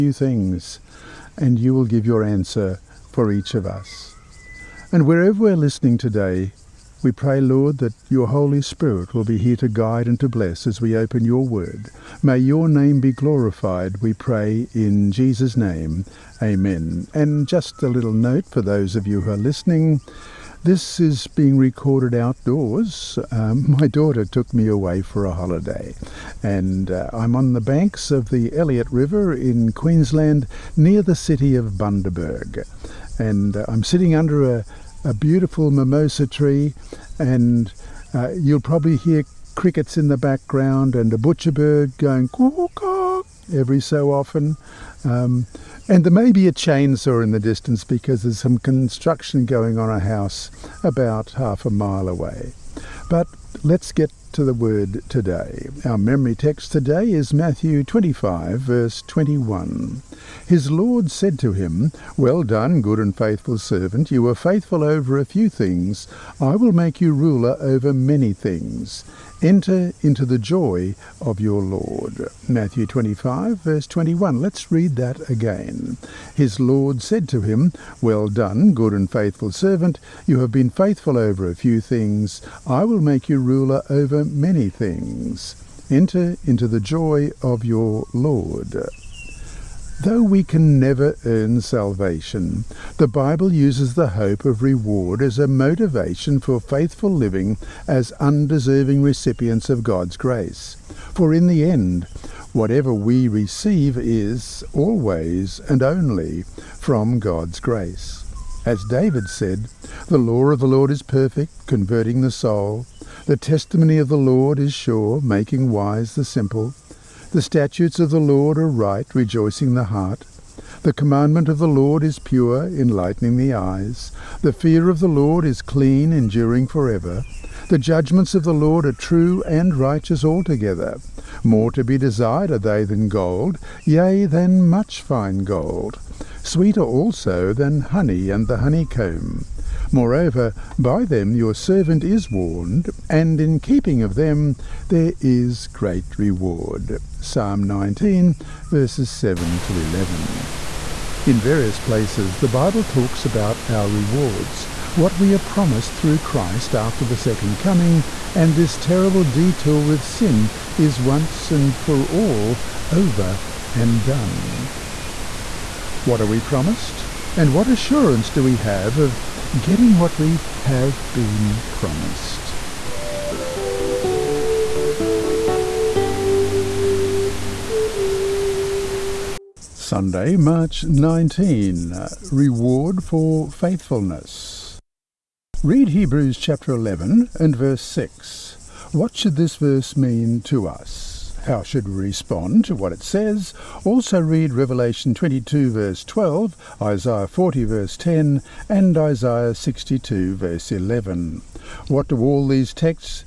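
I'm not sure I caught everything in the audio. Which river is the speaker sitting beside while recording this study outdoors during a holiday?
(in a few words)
Elliott River.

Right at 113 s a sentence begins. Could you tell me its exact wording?
The testimony of the Lord is sure, making wise the simple.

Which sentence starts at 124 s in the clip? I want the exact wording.
The fear of the Lord is clean, enduring forever.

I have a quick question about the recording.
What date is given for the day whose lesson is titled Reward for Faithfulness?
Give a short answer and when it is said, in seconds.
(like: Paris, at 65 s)
Sunday, March 19, at 179 s.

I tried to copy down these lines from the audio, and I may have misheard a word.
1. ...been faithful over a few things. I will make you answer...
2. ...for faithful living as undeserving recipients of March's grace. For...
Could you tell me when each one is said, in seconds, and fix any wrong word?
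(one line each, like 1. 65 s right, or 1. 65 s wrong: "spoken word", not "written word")
1. 80 s wrong: "ruler", not "answer"
2. 96 s wrong: "God", not "March".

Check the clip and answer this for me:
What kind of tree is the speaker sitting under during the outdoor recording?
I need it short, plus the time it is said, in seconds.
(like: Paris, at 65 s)
mimosa, at 35 s.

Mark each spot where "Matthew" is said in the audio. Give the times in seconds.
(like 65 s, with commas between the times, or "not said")
57 s, 72 s.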